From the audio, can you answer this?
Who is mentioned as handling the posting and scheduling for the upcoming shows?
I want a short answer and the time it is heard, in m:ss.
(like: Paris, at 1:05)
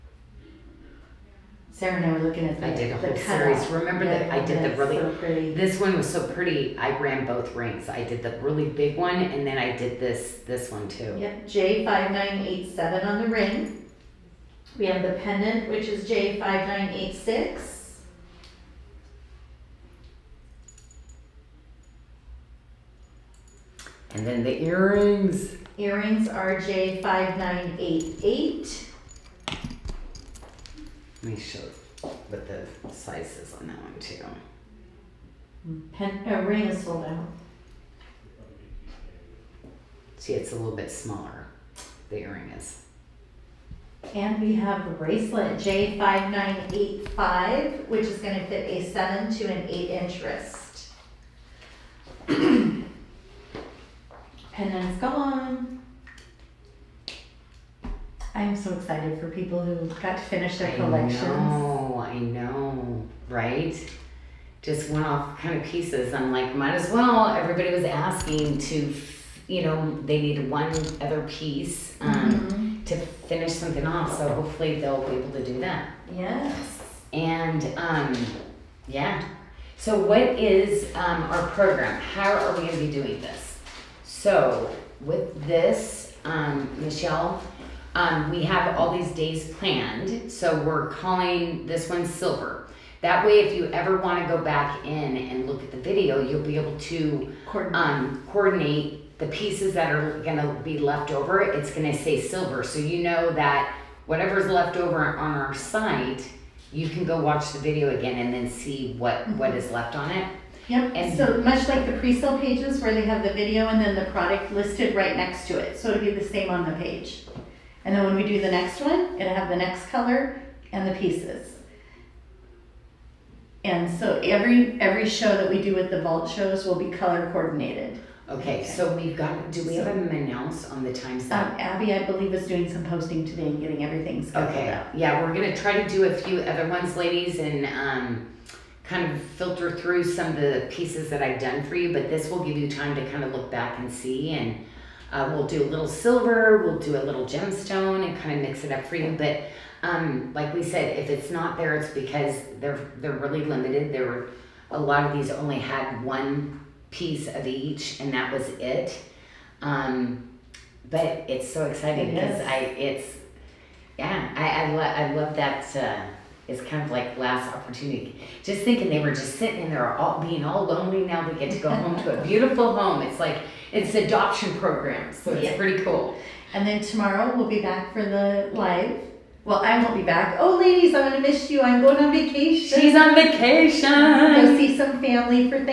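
Abby, at 2:11.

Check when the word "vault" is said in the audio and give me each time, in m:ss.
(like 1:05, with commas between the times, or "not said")
2:06.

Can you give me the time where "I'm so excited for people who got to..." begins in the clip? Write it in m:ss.
0:58.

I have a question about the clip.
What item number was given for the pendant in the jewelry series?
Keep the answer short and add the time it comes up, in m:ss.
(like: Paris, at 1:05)
J5986, at 0:16.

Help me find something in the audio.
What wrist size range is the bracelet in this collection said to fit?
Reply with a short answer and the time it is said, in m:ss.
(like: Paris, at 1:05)
7 to 8 inch, at 0:48.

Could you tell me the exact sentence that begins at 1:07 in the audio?
Everybody was asking to, you know, they need one other piece um, mm-hmm.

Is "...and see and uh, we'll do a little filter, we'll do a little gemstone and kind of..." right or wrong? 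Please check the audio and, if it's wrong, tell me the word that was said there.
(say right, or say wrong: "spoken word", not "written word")
wrong: "silver", not "filter".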